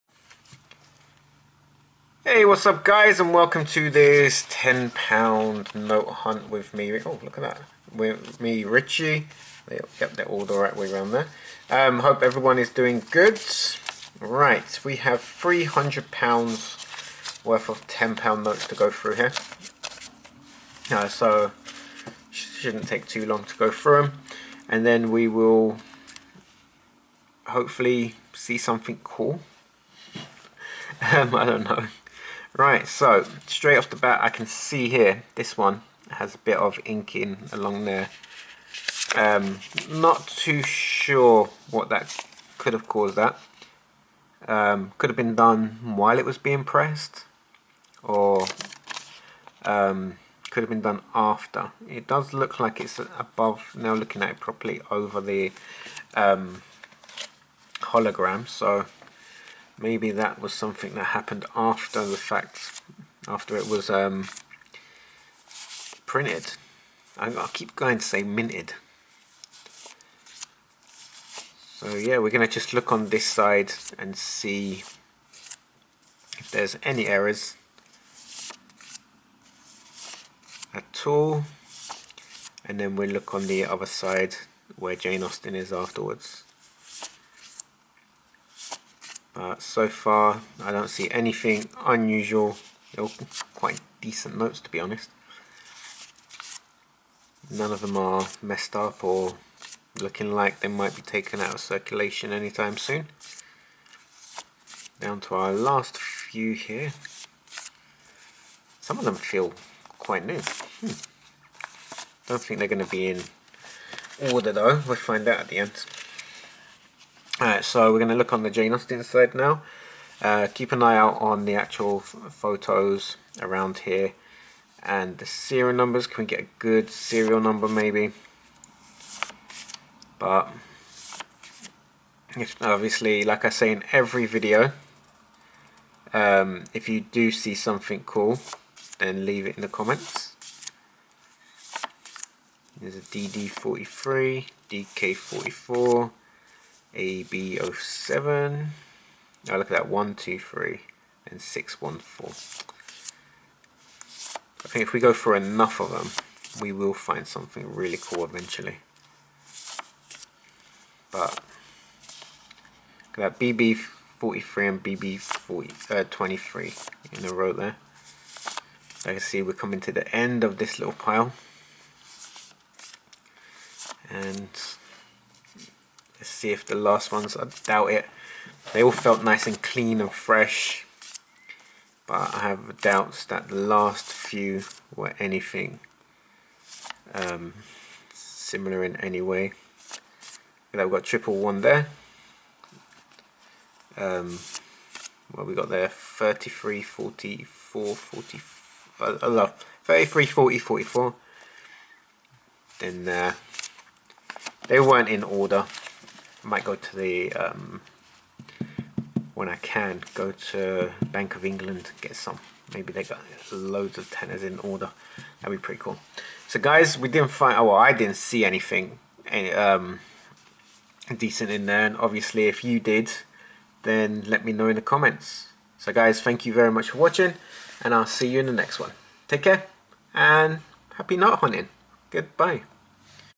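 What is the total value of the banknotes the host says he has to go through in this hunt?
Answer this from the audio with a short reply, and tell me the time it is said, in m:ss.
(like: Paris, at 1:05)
£300, at 0:15.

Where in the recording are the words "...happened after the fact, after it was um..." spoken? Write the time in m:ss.
1:01.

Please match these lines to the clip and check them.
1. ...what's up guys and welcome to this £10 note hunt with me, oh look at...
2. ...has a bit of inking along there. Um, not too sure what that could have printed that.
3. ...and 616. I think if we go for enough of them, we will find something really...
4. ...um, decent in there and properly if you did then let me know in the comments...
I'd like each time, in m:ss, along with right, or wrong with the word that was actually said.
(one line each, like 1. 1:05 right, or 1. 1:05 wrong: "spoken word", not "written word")
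1. 0:02 right
2. 0:36 wrong: "caused", not "printed"
3. 2:31 wrong: "614", not "616"
4. 3:39 wrong: "obviously", not "properly".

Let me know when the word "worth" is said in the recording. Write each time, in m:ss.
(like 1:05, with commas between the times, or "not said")
0:17.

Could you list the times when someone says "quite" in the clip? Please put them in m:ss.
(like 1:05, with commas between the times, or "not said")
1:33, 1:49.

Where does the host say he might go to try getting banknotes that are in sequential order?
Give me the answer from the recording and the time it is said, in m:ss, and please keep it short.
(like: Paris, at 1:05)
Bank of England, at 3:31.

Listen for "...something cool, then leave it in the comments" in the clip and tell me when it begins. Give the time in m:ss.
2:17.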